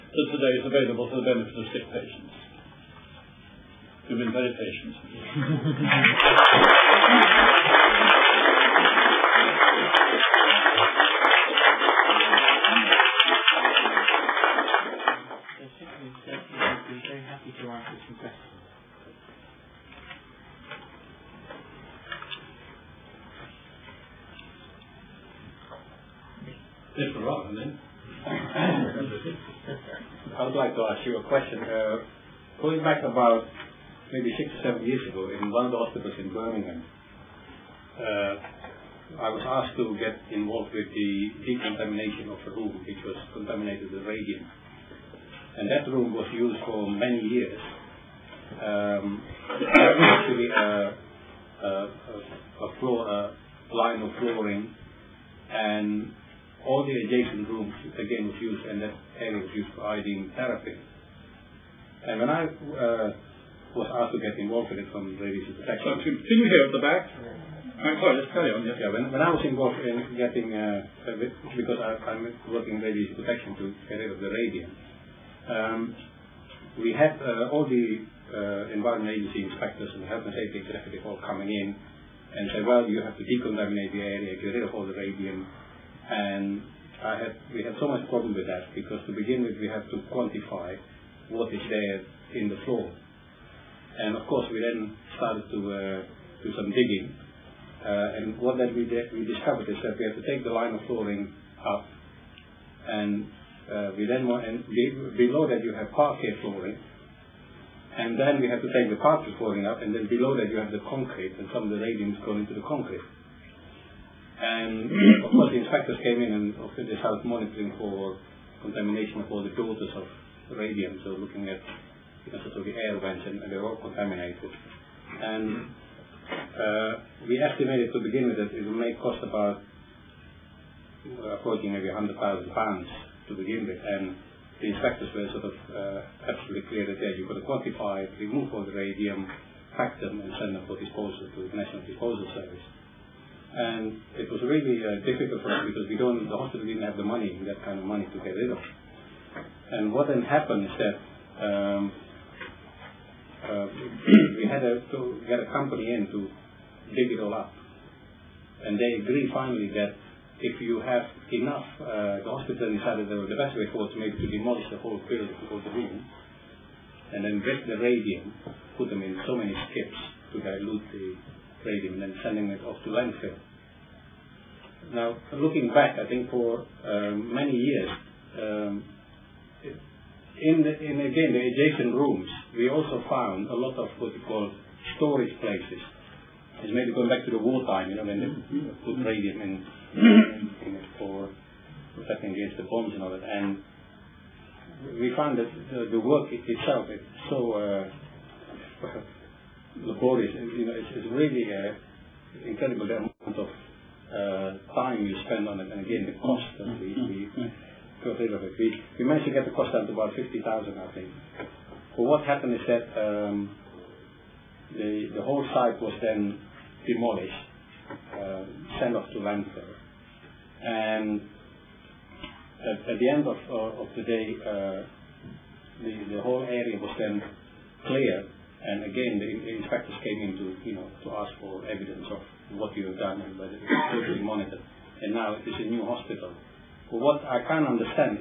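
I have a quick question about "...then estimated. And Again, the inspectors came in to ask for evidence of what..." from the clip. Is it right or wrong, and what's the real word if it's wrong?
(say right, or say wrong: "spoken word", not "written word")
wrong: "cleared", not "estimated".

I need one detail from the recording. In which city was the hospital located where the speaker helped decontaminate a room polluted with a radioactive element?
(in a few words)
Birmingham.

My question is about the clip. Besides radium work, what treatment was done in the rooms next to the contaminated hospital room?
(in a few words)
iodine therapy.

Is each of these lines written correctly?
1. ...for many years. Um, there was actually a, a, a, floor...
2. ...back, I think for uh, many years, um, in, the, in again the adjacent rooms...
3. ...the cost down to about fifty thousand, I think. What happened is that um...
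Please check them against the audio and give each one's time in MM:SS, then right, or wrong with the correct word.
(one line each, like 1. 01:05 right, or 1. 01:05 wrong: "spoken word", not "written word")
1. 00:46 right
2. 02:55 right
3. 03:29 right.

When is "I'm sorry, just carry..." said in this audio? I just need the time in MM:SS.
01:07.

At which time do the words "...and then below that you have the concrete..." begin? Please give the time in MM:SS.
01:49.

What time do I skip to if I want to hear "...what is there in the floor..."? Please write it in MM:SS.
01:31.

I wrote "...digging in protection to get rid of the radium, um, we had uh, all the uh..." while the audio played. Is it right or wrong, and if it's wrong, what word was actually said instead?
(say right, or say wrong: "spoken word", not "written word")
wrong: "working", not "digging".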